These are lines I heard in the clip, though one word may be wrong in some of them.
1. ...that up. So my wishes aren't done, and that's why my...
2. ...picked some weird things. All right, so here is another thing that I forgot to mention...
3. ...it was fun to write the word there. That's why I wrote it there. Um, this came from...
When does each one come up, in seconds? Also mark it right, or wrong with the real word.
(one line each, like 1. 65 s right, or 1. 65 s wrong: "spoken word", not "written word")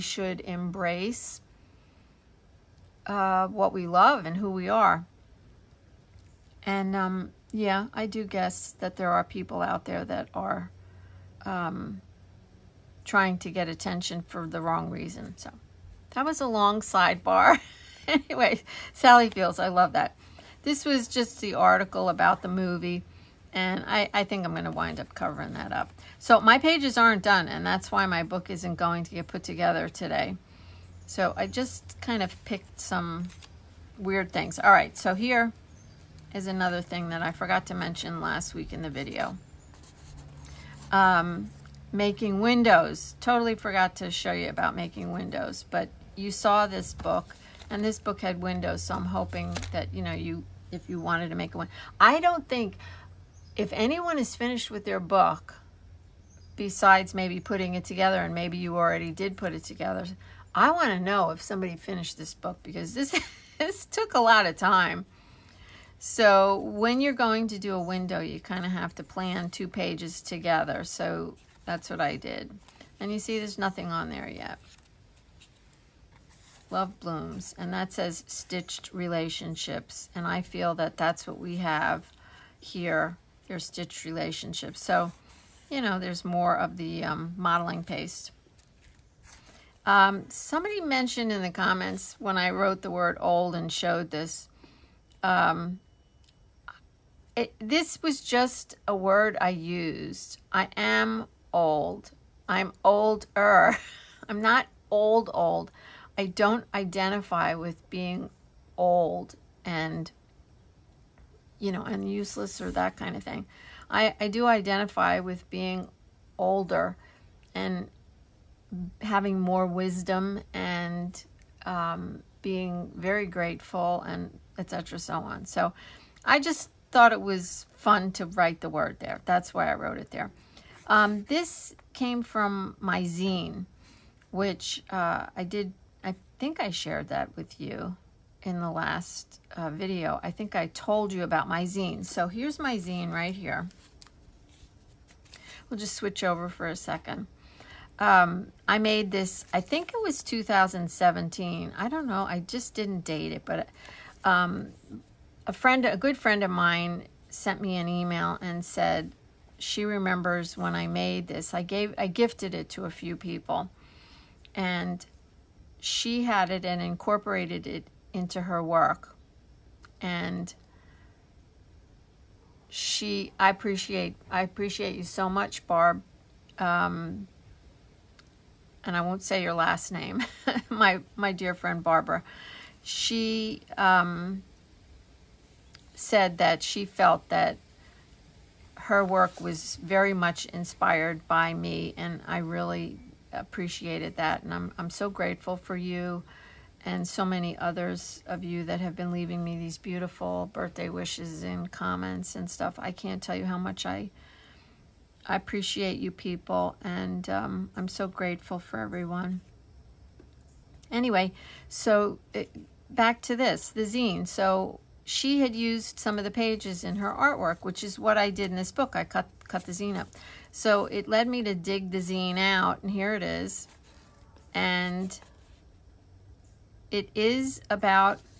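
1. 25 s wrong: "pages", not "wishes"
2. 32 s right
3. 127 s right.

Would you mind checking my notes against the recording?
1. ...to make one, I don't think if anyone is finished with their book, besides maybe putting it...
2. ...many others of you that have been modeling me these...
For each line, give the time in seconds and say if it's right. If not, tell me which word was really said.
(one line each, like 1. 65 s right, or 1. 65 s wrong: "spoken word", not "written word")
1. 51 s right
2. 197 s wrong: "leaving", not "modeling".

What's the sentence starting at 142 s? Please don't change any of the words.
So here's my zine right here.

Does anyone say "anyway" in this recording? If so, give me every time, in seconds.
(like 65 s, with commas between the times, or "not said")
18 s, 210 s.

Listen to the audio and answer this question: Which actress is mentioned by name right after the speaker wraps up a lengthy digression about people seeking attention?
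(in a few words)
Sally Fields.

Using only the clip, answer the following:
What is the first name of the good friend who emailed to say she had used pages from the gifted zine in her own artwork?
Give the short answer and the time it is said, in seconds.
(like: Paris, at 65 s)
Barb, at 175 s.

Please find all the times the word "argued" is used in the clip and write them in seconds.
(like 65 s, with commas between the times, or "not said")
not said.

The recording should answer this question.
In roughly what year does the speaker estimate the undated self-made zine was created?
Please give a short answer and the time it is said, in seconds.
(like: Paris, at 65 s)
2017, at 150 s.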